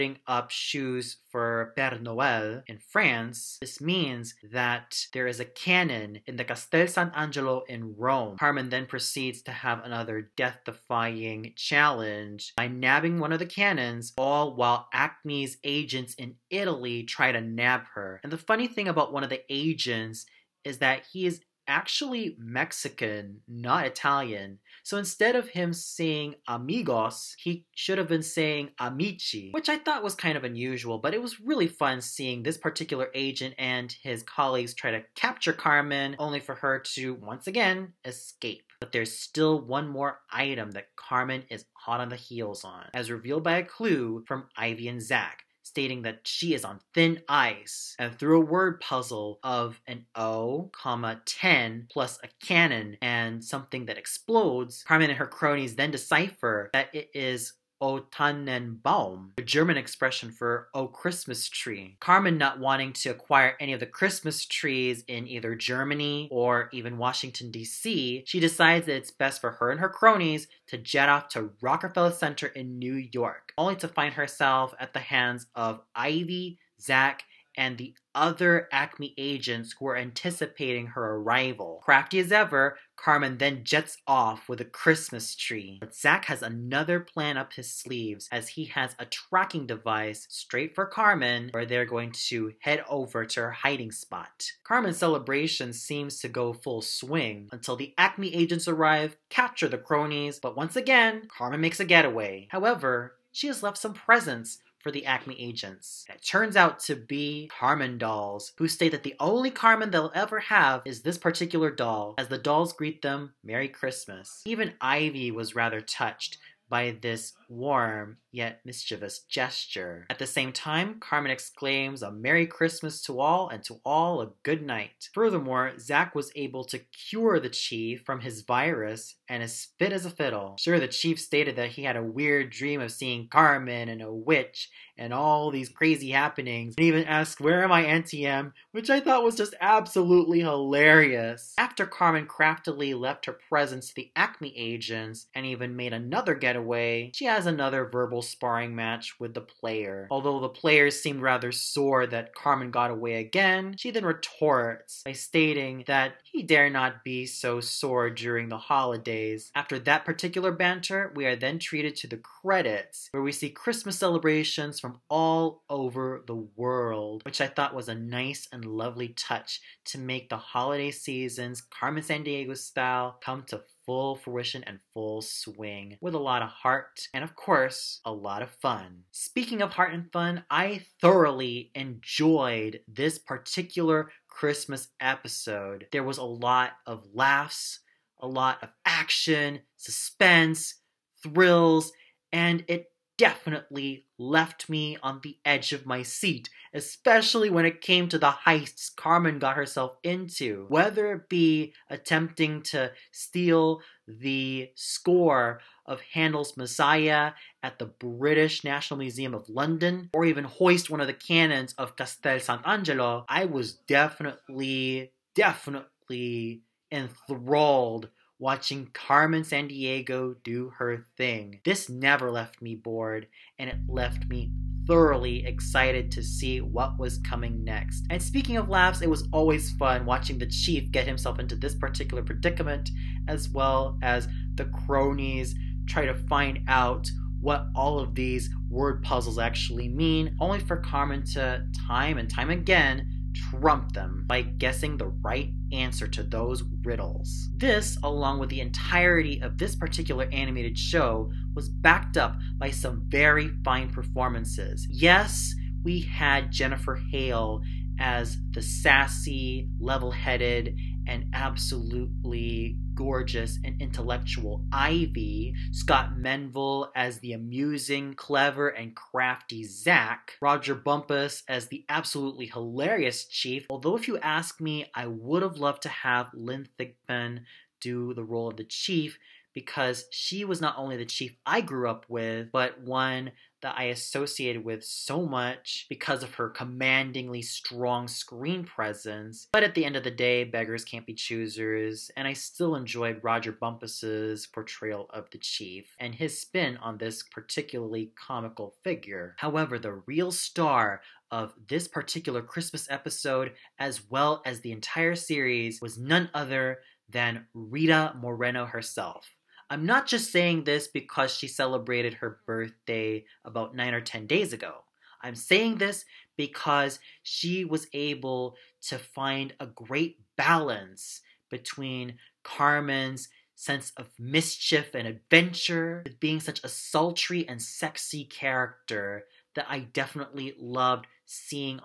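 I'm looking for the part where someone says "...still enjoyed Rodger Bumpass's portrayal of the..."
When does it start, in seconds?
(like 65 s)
292 s.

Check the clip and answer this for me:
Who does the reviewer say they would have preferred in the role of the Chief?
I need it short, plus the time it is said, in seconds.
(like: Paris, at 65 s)
Lynn Thigpen, at 276 s.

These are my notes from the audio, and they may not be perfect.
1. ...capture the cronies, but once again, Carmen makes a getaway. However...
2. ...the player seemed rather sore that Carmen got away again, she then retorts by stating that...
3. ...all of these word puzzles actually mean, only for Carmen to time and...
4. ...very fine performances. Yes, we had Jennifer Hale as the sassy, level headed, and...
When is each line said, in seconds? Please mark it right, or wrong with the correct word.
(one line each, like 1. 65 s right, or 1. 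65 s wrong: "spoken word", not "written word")
1. 99 s right
2. 150 s right
3. 237 s right
4. 253 s right.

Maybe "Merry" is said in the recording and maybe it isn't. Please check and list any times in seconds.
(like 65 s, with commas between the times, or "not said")
113 s, 122 s.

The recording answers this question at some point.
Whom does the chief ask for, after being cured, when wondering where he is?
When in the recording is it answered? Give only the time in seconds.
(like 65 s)
137 s.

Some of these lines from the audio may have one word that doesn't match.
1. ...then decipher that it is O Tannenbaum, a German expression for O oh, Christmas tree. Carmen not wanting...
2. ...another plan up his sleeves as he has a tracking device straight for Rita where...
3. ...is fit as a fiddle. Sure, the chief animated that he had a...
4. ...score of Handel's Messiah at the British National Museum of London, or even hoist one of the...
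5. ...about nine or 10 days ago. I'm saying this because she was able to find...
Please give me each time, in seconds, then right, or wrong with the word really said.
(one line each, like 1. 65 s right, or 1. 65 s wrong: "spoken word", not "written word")
1. 55 s right
2. 86 s wrong: "Carmen", not "Rita"
3. 129 s wrong: "stated", not "animated"
4. 204 s right
5. 313 s right.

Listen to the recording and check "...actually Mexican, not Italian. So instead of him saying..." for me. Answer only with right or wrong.
right.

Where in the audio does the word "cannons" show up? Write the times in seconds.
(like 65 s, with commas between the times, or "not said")
13 s, 52 s, 211 s.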